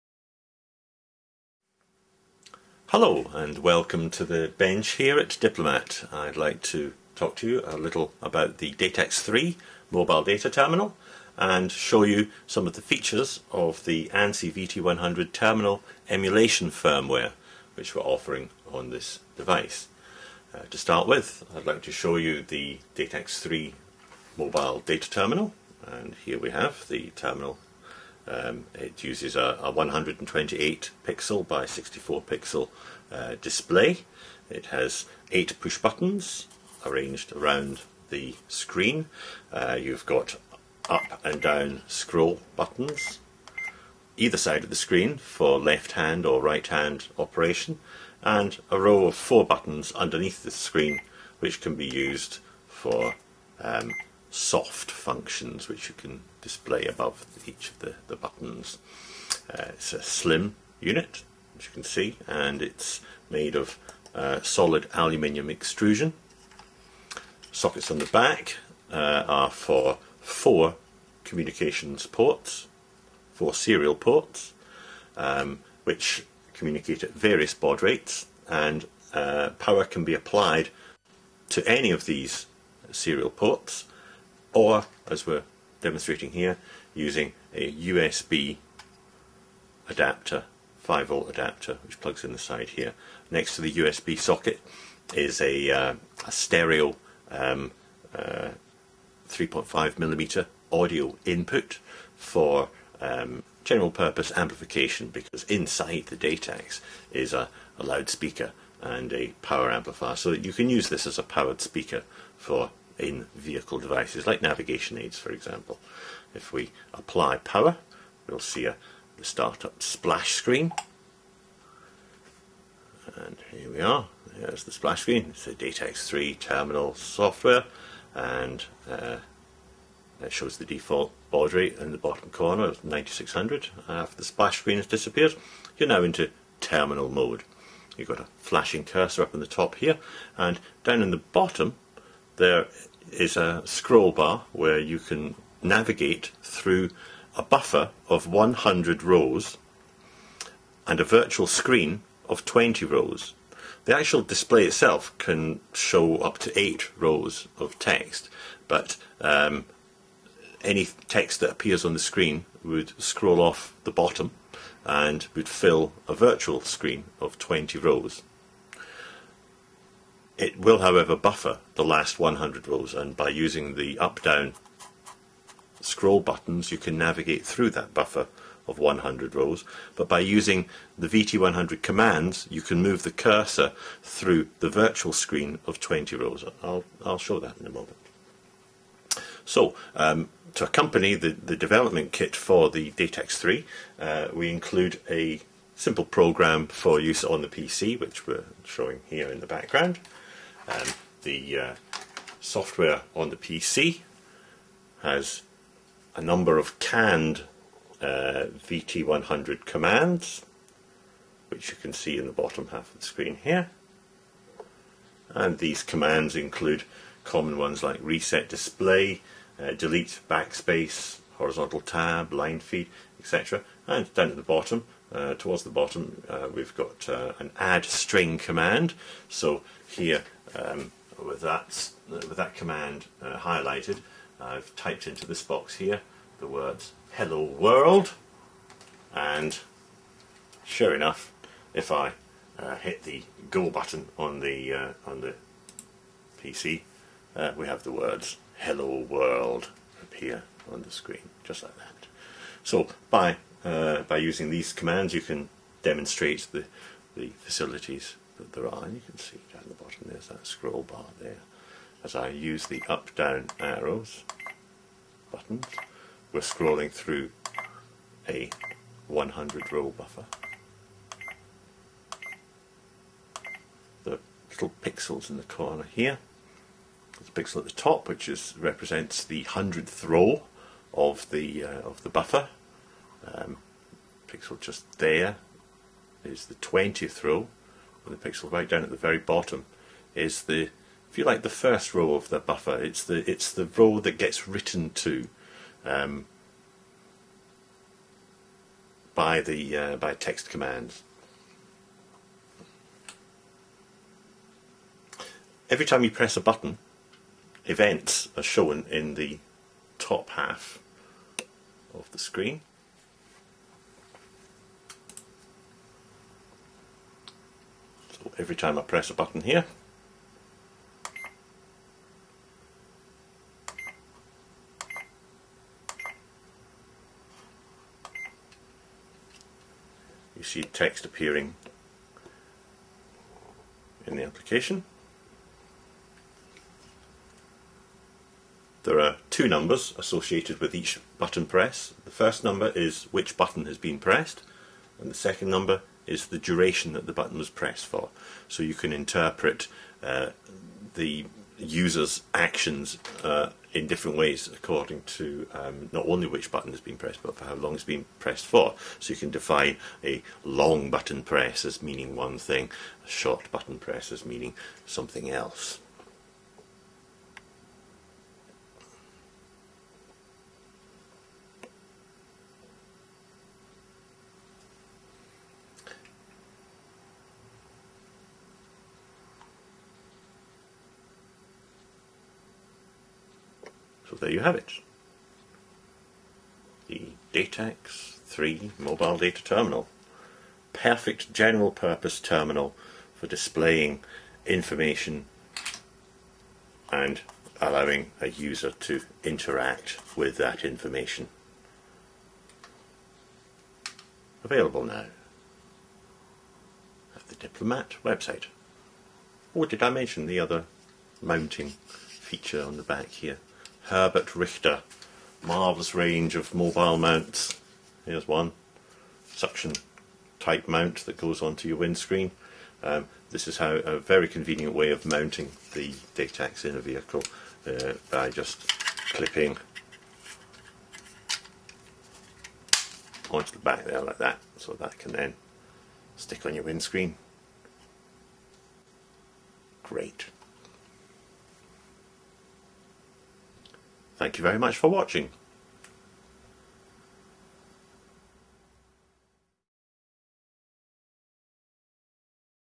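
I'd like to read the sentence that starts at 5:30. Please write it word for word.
You see text appearing in the application.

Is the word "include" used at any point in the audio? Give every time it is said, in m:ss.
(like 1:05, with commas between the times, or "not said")
3:14, 3:36.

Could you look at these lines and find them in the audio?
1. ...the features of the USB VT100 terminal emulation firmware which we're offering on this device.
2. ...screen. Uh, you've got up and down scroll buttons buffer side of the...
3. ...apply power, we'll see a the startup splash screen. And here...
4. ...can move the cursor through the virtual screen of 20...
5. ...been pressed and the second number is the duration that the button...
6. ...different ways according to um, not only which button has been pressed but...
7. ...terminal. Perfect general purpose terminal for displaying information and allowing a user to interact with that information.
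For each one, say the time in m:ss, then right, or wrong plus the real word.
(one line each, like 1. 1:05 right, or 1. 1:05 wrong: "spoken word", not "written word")
1. 0:12 wrong: "ANSI", not "USB"
2. 0:38 wrong: "either", not "buffer"
3. 1:56 right
4. 3:02 right
5. 5:43 right
6. 5:53 right
7. 6:29 right.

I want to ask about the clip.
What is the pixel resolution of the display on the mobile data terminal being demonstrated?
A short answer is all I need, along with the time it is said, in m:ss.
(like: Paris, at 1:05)
128 by 64, at 0:29.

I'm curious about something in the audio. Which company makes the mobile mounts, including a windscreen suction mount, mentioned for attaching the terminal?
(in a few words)
Herbert Richter.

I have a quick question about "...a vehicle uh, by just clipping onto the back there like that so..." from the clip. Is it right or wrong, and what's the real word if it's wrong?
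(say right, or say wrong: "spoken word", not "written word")
right.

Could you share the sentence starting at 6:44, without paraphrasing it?
Available now at the Diplomat website.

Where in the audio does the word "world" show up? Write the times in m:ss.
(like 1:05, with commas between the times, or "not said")
3:57, 4:09.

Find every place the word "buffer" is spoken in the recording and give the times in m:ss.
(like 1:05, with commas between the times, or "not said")
2:27, 2:51, 2:57, 4:29, 4:42, 4:52.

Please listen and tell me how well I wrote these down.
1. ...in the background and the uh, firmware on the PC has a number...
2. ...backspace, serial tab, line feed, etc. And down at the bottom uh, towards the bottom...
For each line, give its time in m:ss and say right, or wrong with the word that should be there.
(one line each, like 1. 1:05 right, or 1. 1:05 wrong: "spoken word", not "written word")
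1. 3:19 wrong: "software", not "firmware"
2. 3:40 wrong: "horizontal", not "serial".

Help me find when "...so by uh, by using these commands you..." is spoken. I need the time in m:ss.
4:12.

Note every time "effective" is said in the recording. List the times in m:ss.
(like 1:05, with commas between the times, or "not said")
not said.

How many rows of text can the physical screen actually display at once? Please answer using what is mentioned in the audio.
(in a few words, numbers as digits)
8.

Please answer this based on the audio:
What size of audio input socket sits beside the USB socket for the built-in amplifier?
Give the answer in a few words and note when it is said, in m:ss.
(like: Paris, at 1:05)
3.5 millimeter, at 1:39.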